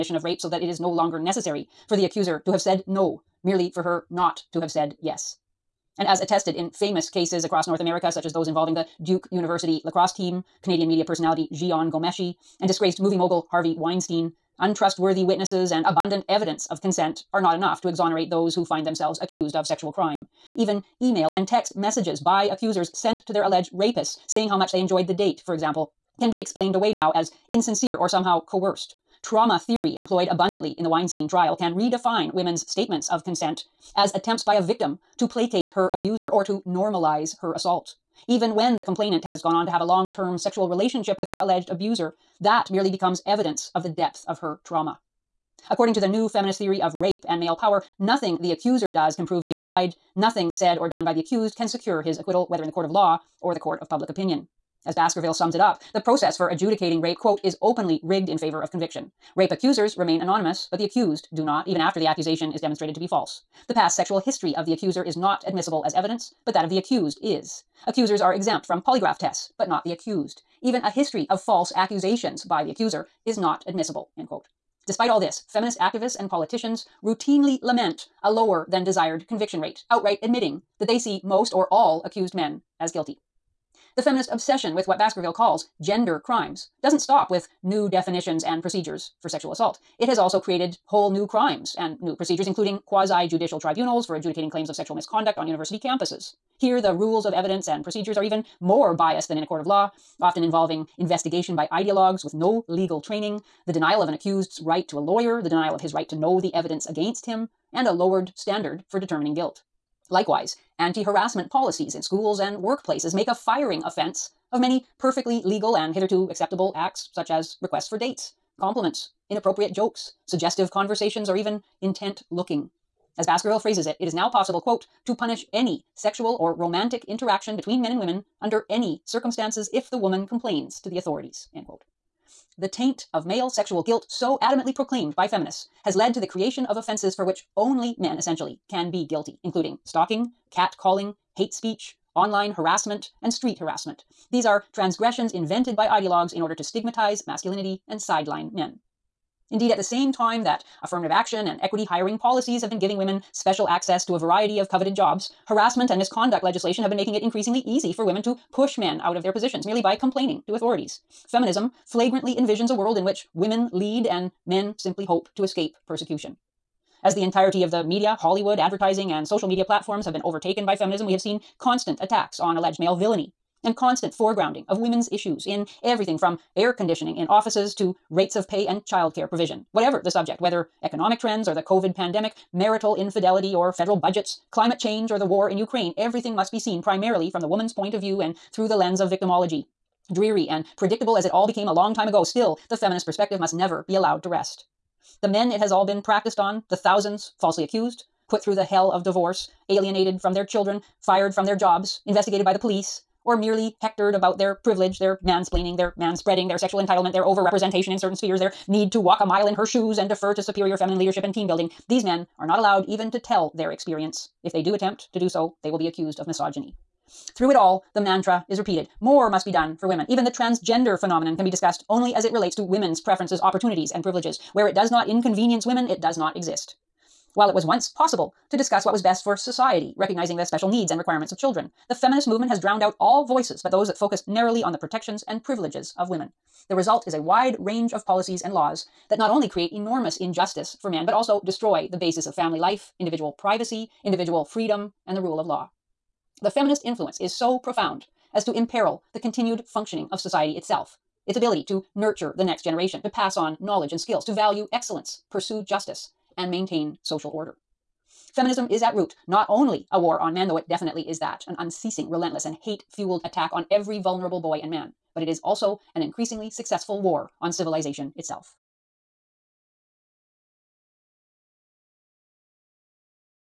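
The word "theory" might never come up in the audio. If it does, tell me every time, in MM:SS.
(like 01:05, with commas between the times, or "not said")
00:29, 00:46.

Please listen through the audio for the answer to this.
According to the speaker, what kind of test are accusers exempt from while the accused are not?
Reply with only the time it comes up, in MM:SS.
01:08.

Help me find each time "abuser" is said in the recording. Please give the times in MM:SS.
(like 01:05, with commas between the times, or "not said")
00:35, 00:41.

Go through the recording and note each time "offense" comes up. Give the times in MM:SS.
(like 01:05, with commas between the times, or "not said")
01:53, 02:16.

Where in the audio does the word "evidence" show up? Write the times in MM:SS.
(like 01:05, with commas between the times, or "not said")
00:16, 00:43, 01:05, 01:37, 01:46.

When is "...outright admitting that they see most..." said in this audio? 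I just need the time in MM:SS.
01:19.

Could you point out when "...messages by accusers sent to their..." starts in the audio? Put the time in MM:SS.
00:21.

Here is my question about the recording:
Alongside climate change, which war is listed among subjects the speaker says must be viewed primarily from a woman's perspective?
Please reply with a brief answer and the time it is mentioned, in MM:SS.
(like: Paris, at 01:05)
The war in Ukraine, at 03:05.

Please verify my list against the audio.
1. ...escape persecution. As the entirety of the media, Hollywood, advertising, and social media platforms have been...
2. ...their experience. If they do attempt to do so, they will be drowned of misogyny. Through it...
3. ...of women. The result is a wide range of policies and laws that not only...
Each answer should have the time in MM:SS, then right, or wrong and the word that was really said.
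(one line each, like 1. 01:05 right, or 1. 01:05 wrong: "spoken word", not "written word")
1. 02:45 right
2. 03:33 wrong: "accused", not "drowned"
3. 03:55 right.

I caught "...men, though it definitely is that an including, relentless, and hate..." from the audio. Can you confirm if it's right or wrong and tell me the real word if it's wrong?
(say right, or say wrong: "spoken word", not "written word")
wrong: "unceasing", not "including".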